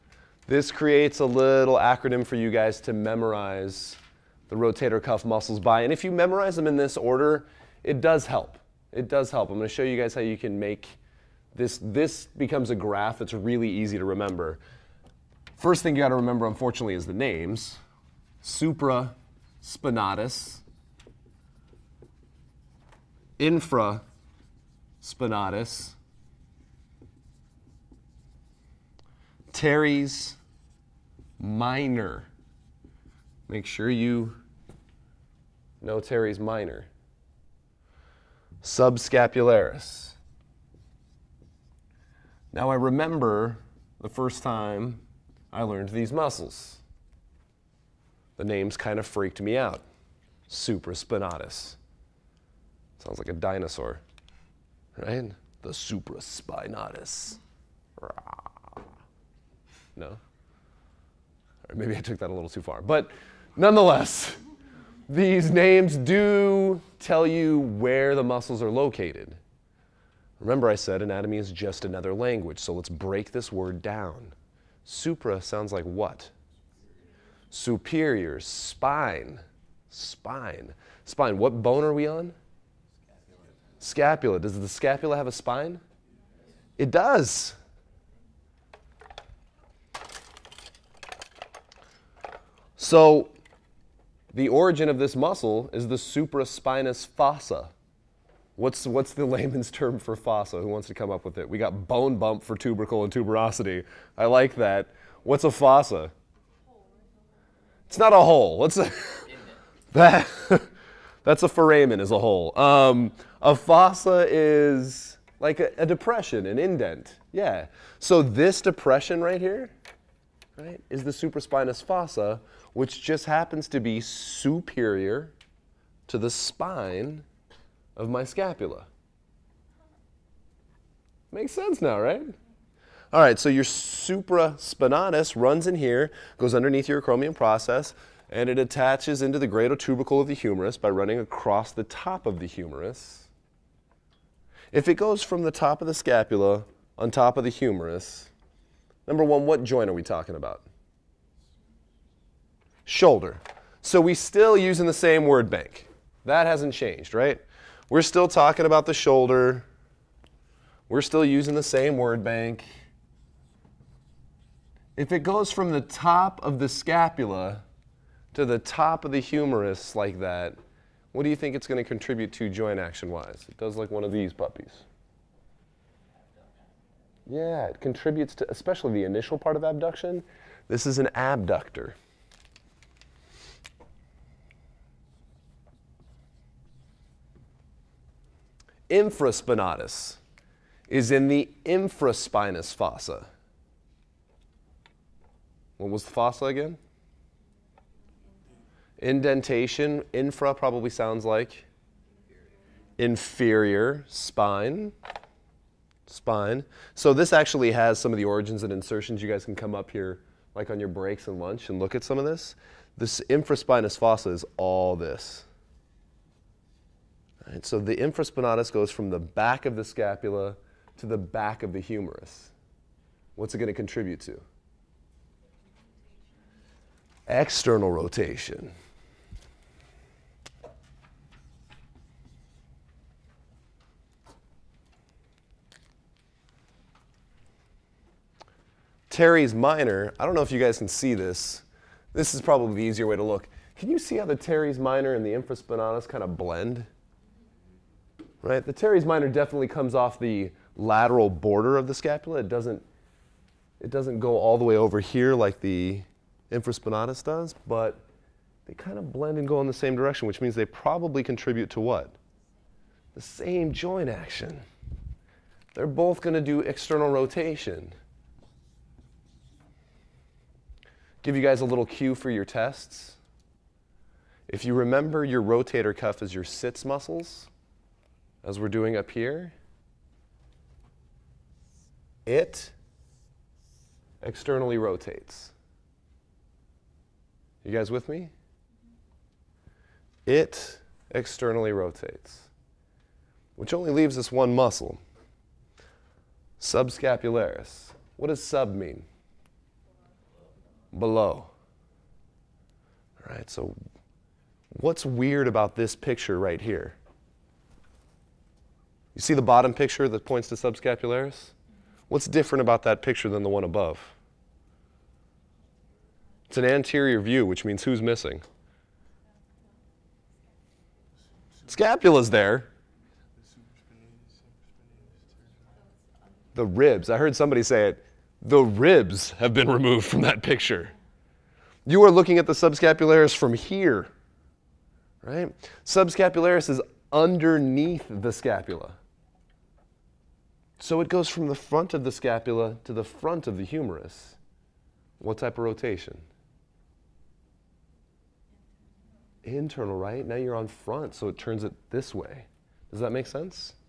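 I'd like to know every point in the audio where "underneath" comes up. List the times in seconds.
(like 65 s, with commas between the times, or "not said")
136 s, 337 s.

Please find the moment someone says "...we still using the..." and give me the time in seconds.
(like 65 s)
154 s.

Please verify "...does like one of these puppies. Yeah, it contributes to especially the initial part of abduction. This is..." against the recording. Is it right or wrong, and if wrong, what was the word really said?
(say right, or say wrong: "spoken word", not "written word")
right.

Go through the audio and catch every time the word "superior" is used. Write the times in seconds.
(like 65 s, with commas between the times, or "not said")
77 s, 124 s.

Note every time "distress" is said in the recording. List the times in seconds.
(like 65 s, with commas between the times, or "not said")
not said.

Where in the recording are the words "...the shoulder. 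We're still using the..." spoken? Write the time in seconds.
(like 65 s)
158 s.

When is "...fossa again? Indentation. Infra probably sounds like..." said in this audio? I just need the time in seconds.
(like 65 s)
196 s.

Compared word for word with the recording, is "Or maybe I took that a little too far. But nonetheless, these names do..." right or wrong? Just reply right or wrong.
right.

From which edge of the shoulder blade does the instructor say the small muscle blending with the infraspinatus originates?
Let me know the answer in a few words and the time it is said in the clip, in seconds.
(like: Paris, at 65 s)
Lateral border, at 250 s.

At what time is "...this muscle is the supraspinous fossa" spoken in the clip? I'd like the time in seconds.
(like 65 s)
94 s.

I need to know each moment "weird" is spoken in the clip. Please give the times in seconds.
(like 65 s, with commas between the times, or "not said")
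305 s.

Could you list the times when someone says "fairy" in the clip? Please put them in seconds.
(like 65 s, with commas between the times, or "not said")
not said.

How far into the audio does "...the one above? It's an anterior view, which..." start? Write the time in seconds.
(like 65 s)
313 s.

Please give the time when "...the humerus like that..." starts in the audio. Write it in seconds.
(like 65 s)
169 s.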